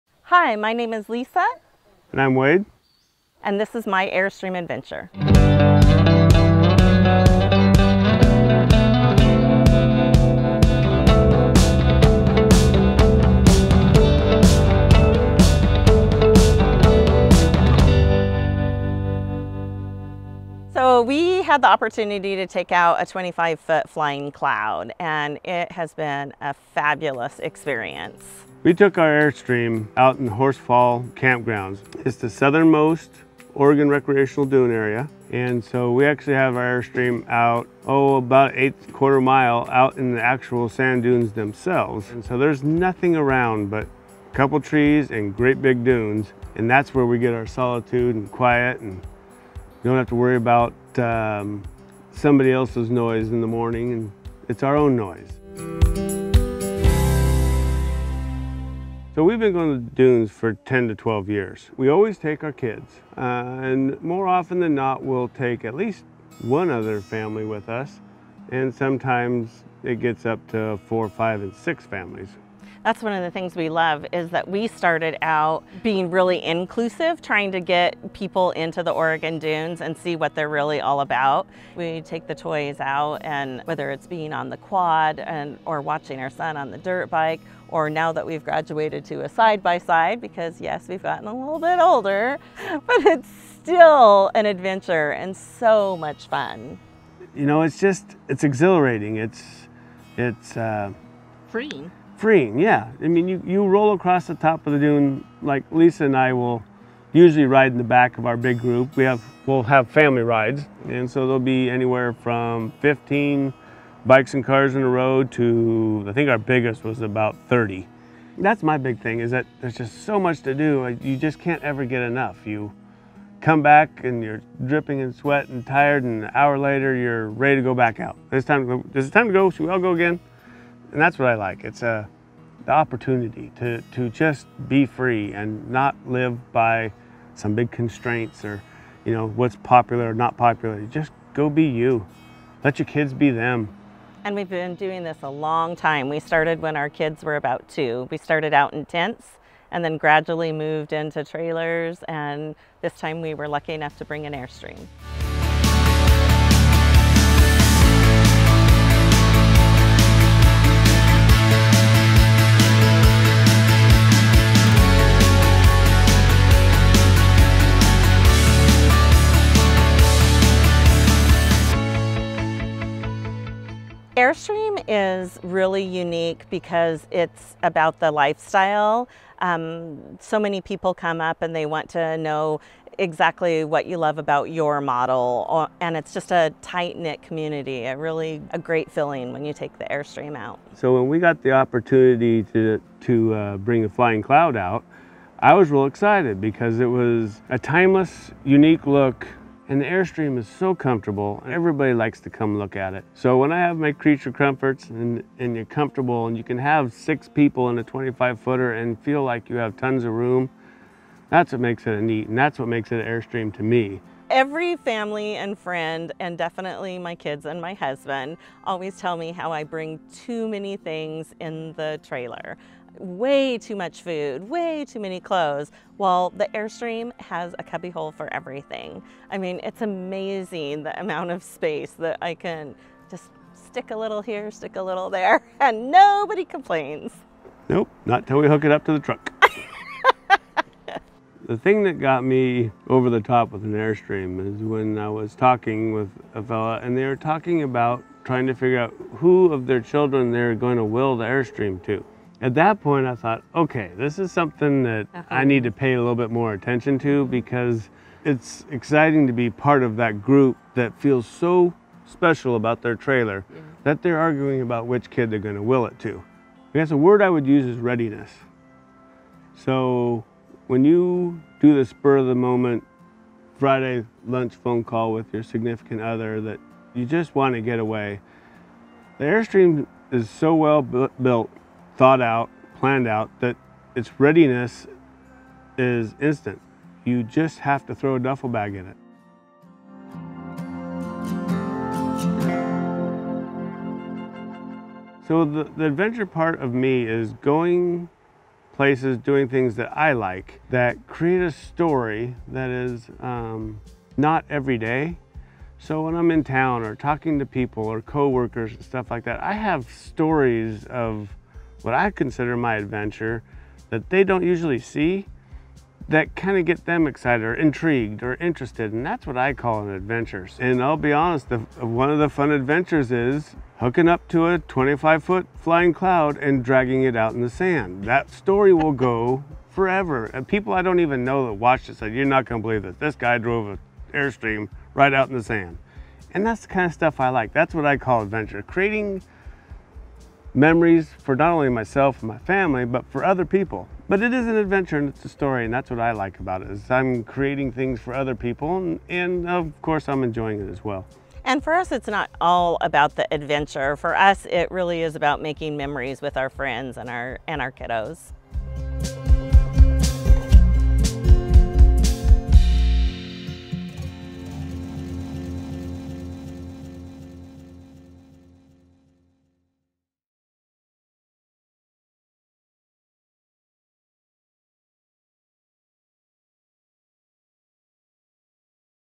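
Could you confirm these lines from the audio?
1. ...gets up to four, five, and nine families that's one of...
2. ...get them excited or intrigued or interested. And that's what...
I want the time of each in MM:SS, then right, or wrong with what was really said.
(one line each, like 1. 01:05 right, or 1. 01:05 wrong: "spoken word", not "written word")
1. 01:09 wrong: "six", not "nine"
2. 05:16 right.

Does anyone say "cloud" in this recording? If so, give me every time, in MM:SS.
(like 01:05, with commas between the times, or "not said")
00:24, 03:14, 05:25.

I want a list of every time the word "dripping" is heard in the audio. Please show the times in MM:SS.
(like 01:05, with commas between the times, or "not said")
02:04.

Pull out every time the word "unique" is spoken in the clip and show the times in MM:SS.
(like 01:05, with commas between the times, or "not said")
02:55, 03:18.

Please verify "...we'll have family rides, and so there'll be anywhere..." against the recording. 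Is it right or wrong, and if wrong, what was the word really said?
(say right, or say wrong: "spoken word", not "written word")
right.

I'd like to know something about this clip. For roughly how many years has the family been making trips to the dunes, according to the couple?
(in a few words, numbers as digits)
10 to 12.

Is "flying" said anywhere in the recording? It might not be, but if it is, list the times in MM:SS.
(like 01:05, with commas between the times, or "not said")
00:23, 03:13, 05:25.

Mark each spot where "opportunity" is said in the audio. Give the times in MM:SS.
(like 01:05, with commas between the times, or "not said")
00:21, 02:12, 03:11.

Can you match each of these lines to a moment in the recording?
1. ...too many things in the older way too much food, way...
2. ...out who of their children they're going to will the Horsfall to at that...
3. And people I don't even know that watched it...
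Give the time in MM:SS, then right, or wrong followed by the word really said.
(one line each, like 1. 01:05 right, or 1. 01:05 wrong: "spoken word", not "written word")
1. 03:40 wrong: "trailer", not "older"
2. 04:08 wrong: "Airstream", not "Horsfall"
3. 05:30 right.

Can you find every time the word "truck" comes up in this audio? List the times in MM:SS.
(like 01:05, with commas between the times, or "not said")
03:58.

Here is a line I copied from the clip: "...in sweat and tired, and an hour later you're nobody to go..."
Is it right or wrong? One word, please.
wrong.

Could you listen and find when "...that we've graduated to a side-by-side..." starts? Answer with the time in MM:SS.
01:28.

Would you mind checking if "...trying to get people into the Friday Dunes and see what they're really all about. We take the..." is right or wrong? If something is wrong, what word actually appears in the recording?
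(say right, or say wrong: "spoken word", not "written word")
wrong: "Oregon", not "Friday".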